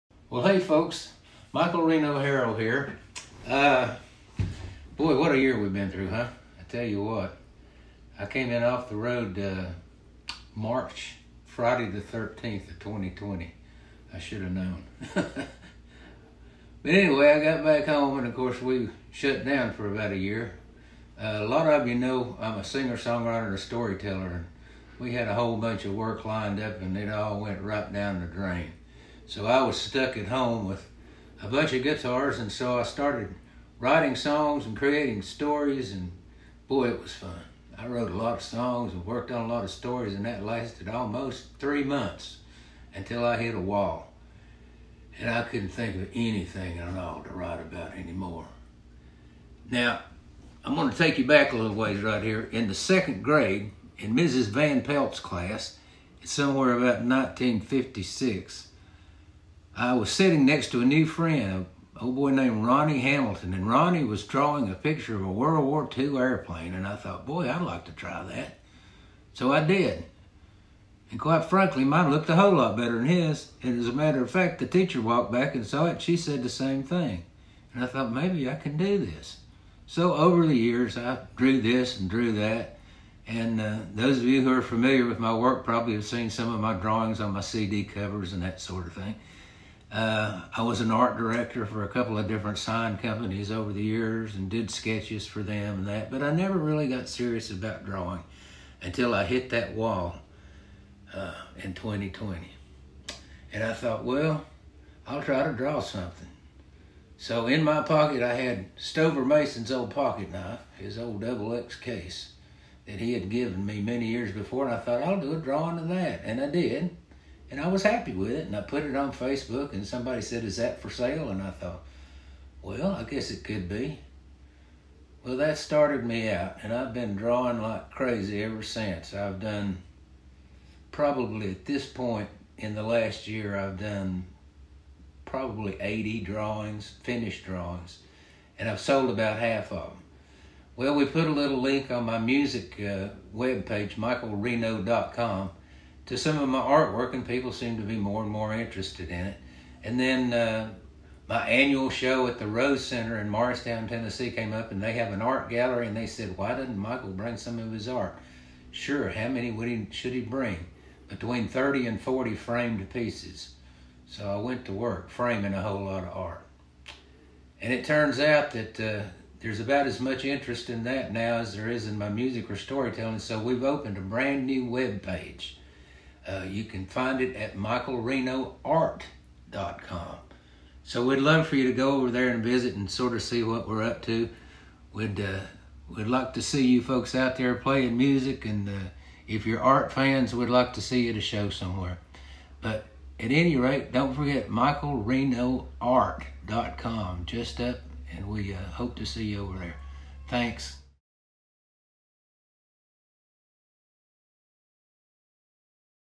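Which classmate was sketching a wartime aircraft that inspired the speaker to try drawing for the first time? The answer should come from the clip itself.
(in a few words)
Ronnie Hamilton.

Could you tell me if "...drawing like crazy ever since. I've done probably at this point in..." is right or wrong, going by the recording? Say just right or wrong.
right.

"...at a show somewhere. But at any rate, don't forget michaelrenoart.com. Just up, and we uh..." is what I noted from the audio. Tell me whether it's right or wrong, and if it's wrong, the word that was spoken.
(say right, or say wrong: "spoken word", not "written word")
right.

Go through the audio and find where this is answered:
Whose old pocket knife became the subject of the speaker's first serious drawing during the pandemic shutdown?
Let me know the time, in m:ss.
1:48.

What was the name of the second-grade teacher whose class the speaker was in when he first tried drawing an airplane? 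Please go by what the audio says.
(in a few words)
Mrs. Van Pelt.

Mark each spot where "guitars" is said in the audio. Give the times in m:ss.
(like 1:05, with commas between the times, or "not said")
0:31.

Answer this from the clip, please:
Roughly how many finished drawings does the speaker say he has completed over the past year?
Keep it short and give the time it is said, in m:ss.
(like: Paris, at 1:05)
80, at 2:15.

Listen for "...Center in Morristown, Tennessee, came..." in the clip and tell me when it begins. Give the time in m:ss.
2:32.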